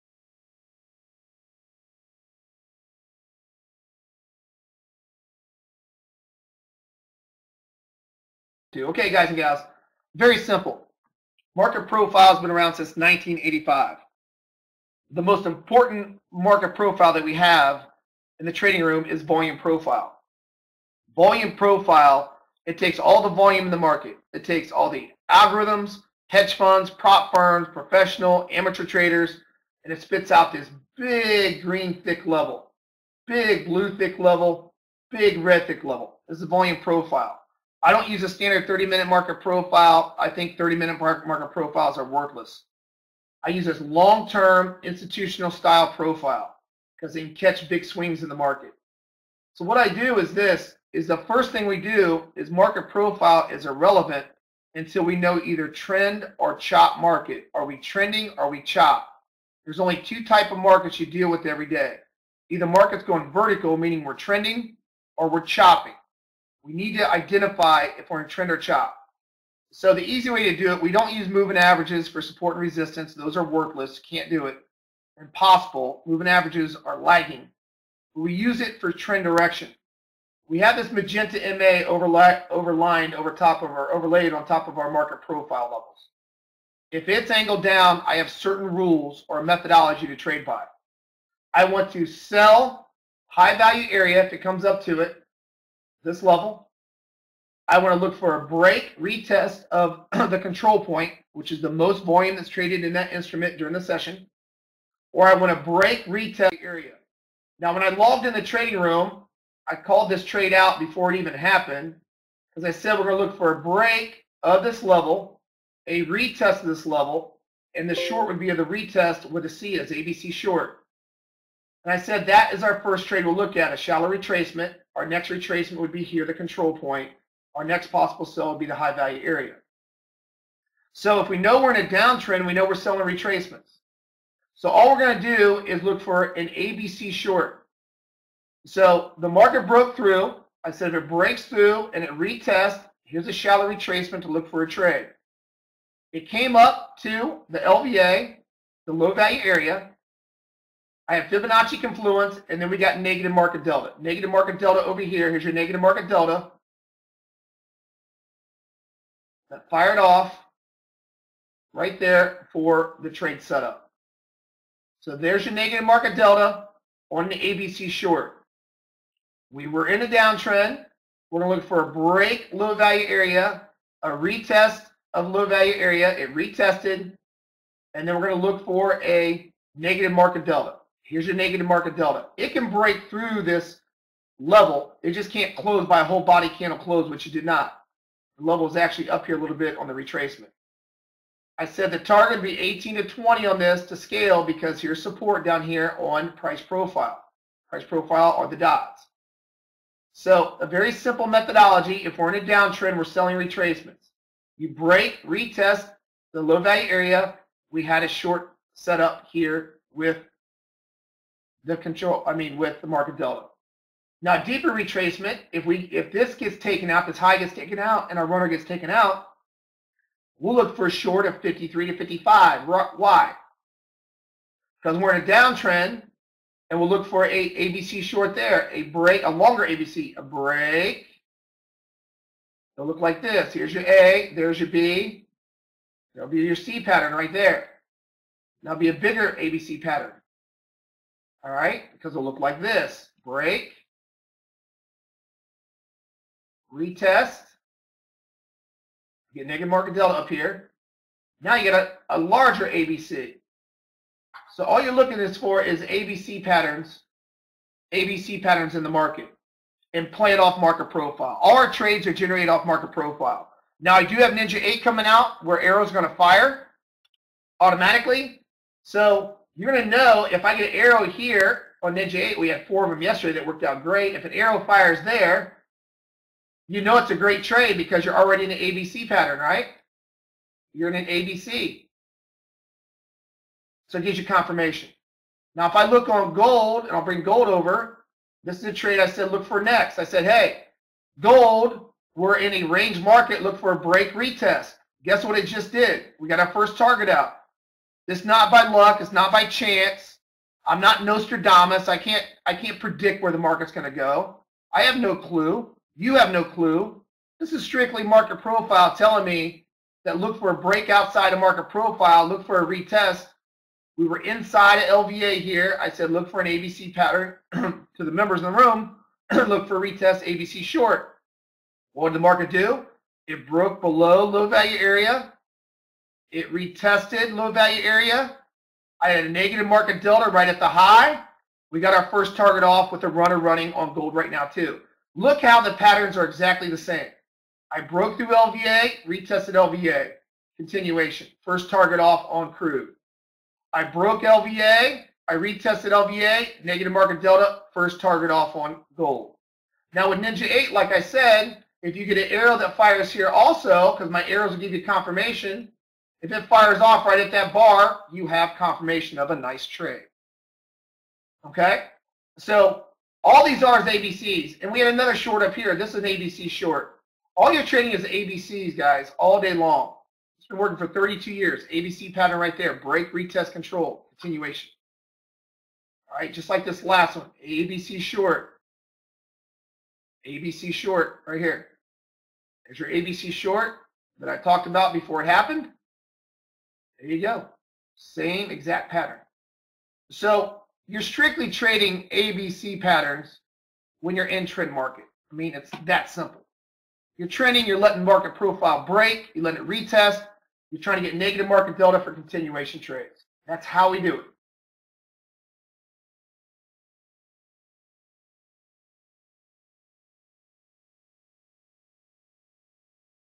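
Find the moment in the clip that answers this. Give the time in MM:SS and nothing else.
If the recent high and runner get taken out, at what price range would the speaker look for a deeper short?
03:41.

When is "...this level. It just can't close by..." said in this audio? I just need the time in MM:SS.
03:03.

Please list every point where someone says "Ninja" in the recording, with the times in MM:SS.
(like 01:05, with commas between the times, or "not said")
04:24, 04:31, 05:50.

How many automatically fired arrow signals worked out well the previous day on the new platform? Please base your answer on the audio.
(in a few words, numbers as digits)
4.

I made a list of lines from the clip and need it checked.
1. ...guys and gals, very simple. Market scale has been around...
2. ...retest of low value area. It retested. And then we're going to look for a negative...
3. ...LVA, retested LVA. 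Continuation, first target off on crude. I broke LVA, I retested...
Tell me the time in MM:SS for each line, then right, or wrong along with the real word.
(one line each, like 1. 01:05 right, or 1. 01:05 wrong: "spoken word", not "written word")
1. 00:09 wrong: "profile", not "scale"
2. 02:54 right
3. 05:38 right.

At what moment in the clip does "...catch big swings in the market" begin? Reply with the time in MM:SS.
00:47.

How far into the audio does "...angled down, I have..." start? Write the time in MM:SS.
01:27.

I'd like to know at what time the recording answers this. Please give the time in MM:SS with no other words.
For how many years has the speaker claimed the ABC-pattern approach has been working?
06:10.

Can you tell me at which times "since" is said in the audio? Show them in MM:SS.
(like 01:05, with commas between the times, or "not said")
00:12.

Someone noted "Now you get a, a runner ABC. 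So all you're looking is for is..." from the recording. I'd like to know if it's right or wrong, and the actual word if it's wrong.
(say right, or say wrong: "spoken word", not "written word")
wrong: "larger", not "runner".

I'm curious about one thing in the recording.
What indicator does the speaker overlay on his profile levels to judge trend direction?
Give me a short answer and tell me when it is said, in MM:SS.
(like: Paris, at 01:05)
Magenta MA, at 01:20.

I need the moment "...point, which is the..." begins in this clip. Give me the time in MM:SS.
01:40.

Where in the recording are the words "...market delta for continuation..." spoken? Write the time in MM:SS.
06:41.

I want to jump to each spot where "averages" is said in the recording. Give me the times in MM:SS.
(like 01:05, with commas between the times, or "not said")
01:11, 01:16.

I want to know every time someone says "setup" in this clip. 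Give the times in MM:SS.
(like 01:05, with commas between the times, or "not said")
02:43, 03:28.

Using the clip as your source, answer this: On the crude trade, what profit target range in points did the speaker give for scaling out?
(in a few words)
18 to 20.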